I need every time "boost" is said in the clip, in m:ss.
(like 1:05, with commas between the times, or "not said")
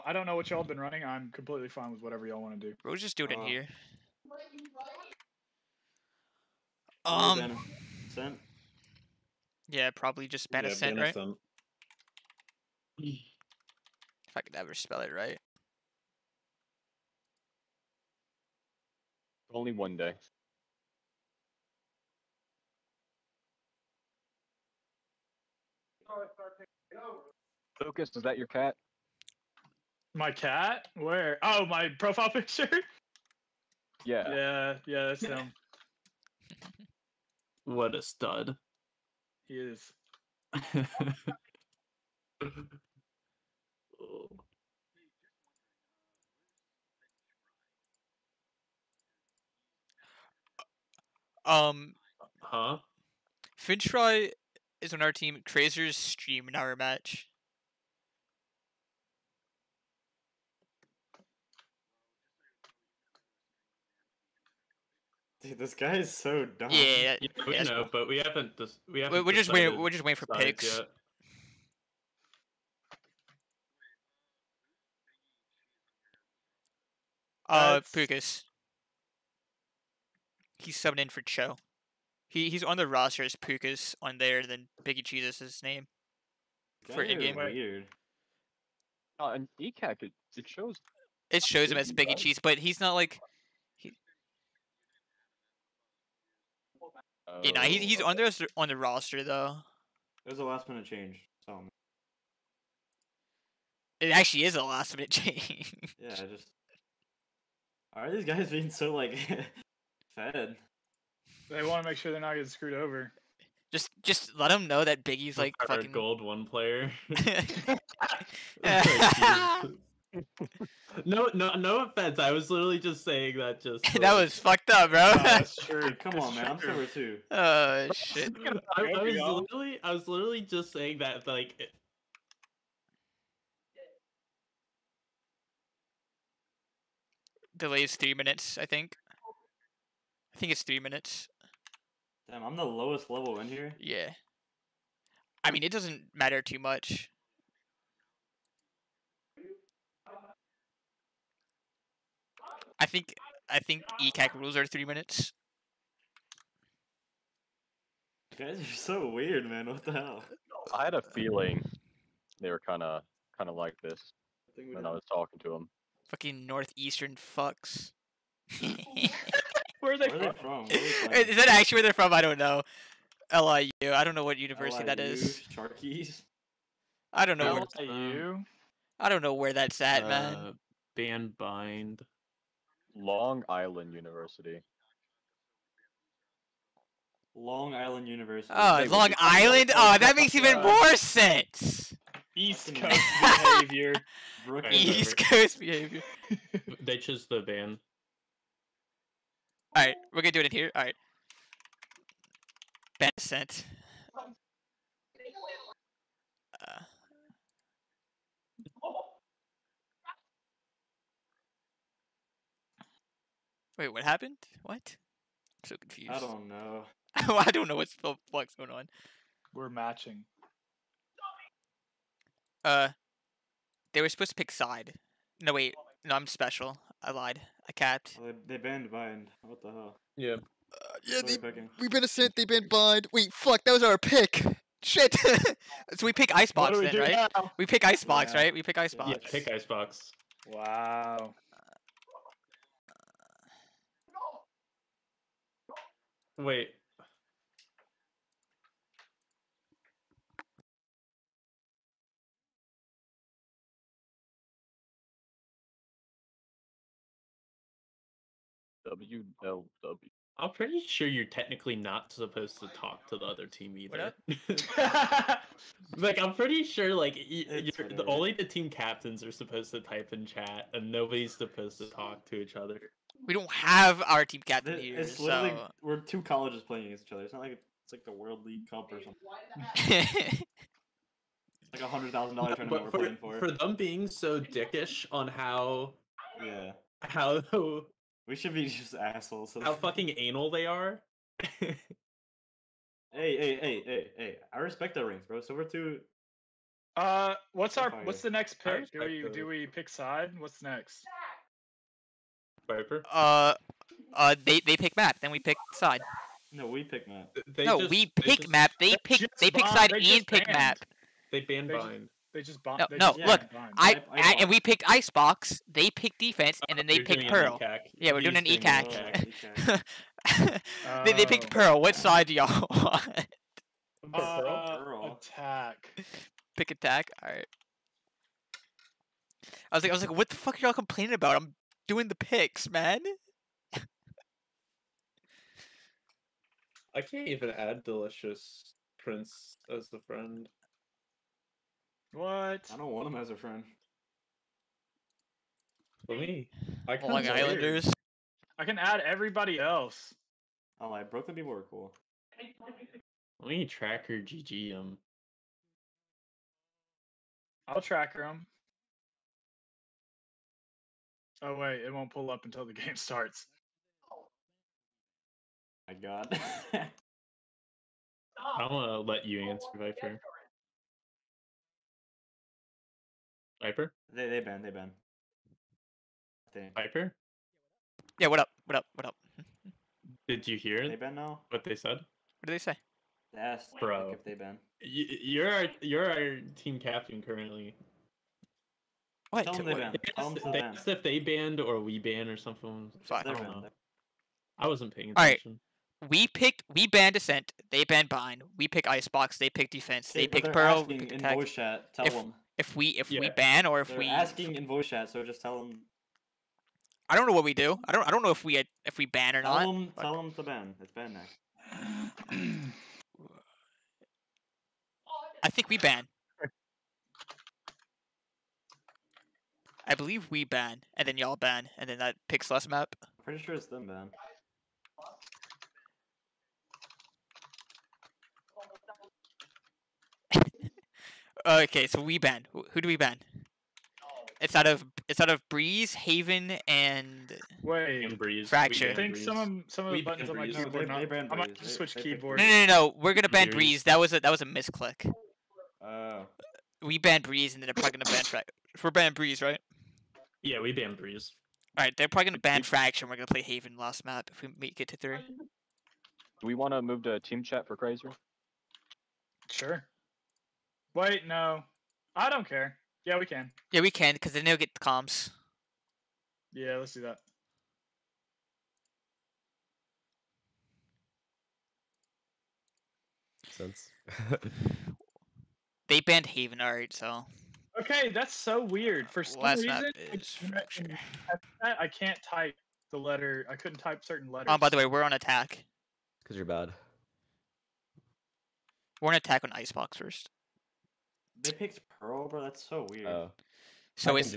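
not said.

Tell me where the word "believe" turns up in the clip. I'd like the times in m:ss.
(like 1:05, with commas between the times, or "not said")
6:59.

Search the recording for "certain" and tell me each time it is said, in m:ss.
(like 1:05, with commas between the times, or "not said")
8:04.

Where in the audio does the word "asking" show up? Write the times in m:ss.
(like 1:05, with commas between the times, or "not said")
6:44.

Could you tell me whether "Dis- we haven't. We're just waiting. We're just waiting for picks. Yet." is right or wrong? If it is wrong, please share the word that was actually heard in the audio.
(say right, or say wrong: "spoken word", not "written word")
right.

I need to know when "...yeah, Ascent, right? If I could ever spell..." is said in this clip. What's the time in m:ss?
0:10.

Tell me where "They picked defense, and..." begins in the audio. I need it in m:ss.
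5:15.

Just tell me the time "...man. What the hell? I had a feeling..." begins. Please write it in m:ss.
2:39.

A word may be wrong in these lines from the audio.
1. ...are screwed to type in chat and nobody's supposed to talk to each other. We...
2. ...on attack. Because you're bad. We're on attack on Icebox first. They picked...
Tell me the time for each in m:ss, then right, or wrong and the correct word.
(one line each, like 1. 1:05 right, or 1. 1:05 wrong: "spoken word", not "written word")
1. 4:29 wrong: "supposed", not "screwed"
2. 8:05 right.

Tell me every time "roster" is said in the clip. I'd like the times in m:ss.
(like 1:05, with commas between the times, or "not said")
1:22, 1:38.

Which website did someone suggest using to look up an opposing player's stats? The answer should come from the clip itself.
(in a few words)
tracker GG.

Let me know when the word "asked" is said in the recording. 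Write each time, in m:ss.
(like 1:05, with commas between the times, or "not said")
6:23, 6:30.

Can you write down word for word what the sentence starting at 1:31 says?
It shows him as Biggie Cheese, but he's not like.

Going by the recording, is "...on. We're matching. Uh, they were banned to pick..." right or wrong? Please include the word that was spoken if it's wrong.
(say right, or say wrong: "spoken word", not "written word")
wrong: "supposed", not "banned".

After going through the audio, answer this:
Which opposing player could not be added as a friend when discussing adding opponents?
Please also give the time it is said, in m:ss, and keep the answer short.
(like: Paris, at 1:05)
delicious prince, at 5:37.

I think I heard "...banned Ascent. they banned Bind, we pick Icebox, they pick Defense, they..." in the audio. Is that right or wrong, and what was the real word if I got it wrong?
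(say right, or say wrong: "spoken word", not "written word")
right.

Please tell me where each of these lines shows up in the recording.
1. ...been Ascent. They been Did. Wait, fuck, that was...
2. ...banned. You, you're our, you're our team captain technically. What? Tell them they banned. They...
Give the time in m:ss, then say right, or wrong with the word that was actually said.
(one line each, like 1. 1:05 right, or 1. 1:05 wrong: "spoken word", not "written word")
1. 3:51 wrong: "Bind", not "Did"
2. 6:24 wrong: "currently", not "technically".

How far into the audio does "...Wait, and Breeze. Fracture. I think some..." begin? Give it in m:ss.
7:17.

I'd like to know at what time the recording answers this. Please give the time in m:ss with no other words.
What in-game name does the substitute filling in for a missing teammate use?
1:24.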